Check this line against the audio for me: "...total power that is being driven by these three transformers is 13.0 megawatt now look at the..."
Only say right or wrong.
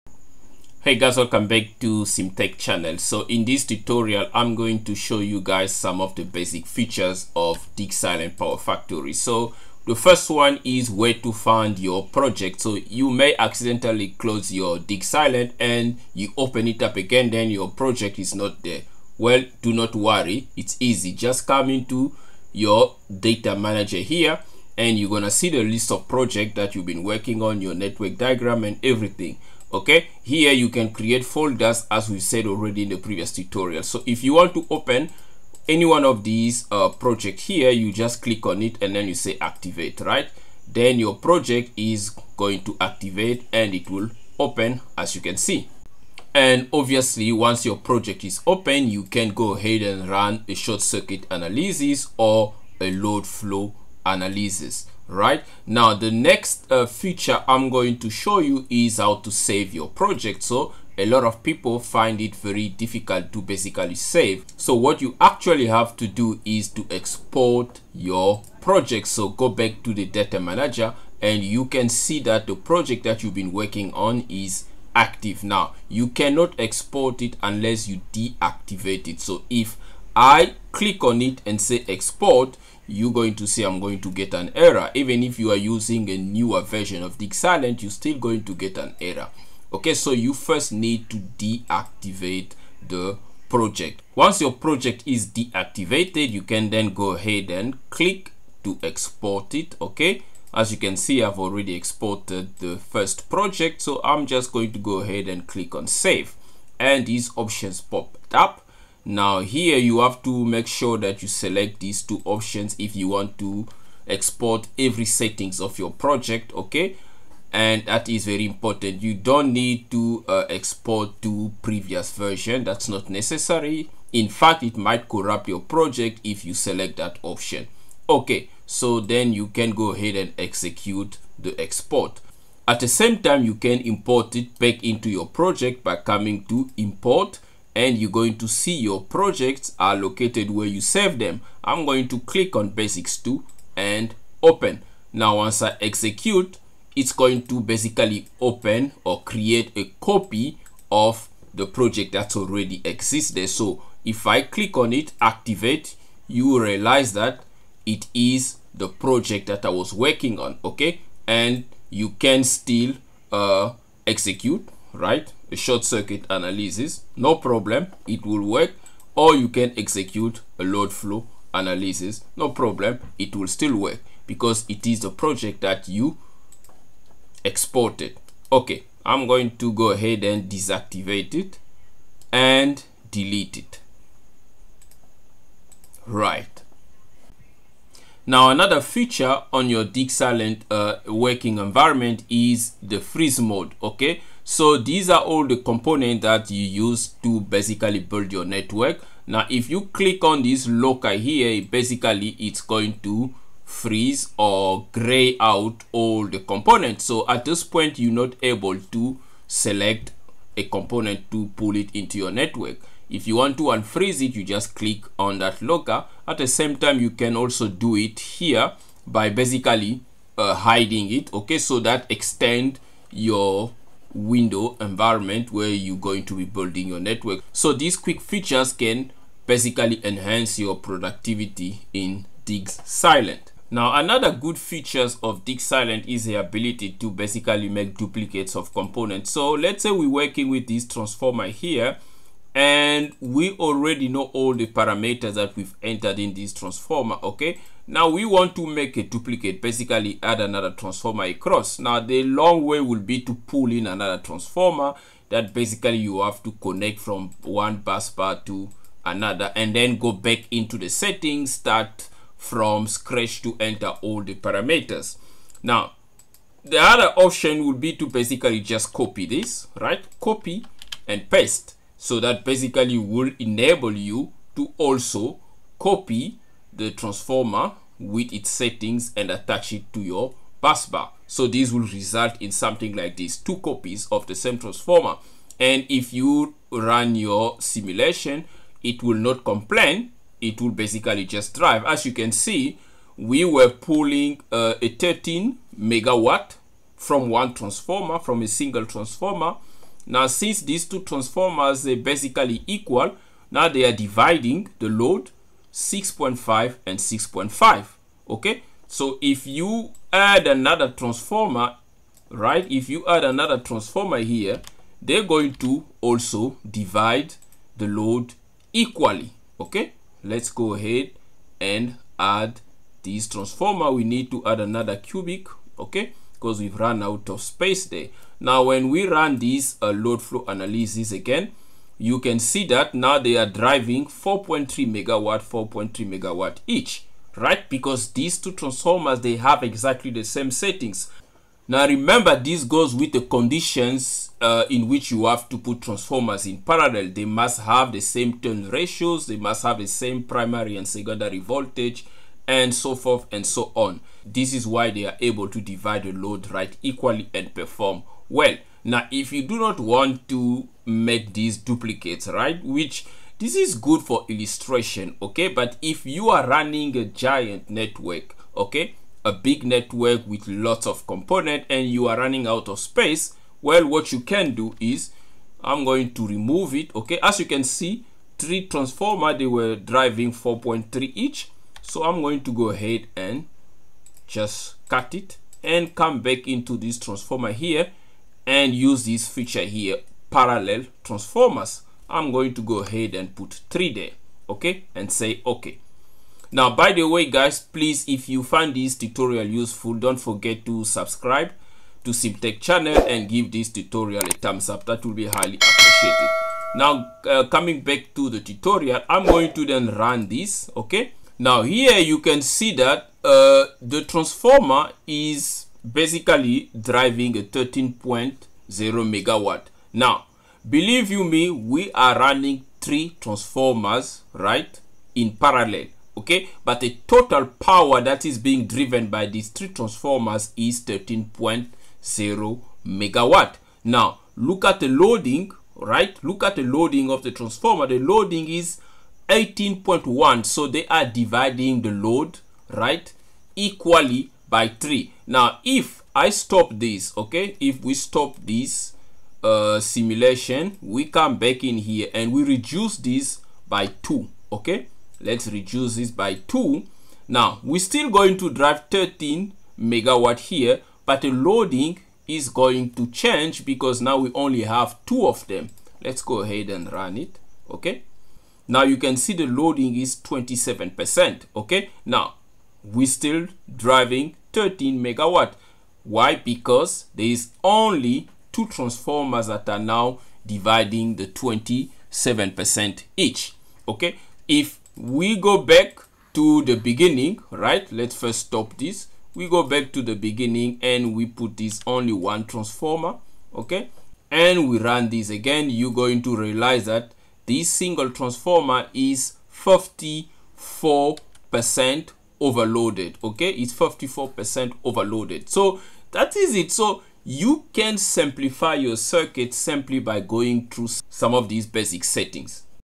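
right.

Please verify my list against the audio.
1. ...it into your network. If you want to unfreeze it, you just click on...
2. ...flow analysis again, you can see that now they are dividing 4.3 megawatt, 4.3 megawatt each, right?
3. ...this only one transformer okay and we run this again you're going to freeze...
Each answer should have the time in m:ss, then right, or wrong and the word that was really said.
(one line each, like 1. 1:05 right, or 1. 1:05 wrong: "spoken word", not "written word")
1. 3:31 right
2. 5:30 wrong: "driving", not "dividing"
3. 8:11 wrong: "realize", not "freeze".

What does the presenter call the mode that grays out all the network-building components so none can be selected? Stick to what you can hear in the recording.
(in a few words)
freeze mode.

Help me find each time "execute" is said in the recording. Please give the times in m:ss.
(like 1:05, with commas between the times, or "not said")
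2:10, 2:25, 2:44, 2:49.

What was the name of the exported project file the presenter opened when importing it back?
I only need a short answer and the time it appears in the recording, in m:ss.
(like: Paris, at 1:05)
basics 2, at 2:22.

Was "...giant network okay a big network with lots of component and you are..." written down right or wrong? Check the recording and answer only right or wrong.
right.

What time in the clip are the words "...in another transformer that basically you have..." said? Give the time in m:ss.
4:13.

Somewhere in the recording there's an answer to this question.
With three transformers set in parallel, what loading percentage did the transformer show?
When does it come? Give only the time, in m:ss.
7:19.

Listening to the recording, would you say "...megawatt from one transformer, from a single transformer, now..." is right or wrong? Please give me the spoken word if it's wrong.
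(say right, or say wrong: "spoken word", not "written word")
right.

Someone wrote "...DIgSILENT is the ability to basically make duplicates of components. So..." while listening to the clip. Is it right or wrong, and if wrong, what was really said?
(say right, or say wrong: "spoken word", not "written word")
right.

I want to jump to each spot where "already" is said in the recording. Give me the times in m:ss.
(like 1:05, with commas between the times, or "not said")
0:32, 1:41, 2:32, 4:03.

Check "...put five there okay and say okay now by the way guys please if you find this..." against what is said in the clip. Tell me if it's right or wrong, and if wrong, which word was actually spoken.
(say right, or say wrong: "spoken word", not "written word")
wrong: "three", not "five".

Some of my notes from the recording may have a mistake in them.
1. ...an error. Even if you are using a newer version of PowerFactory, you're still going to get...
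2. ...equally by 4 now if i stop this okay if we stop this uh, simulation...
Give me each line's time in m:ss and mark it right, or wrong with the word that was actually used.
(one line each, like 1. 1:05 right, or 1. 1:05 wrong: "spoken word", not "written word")
1. 1:24 wrong: "Silent", not "PowerFactory"
2. 7:23 wrong: "3", not "4".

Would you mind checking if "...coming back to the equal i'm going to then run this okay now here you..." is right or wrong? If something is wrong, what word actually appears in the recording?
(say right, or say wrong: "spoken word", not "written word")
wrong: "tutorial", not "equal".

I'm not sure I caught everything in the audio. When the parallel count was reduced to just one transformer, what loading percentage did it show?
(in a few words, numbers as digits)
54%.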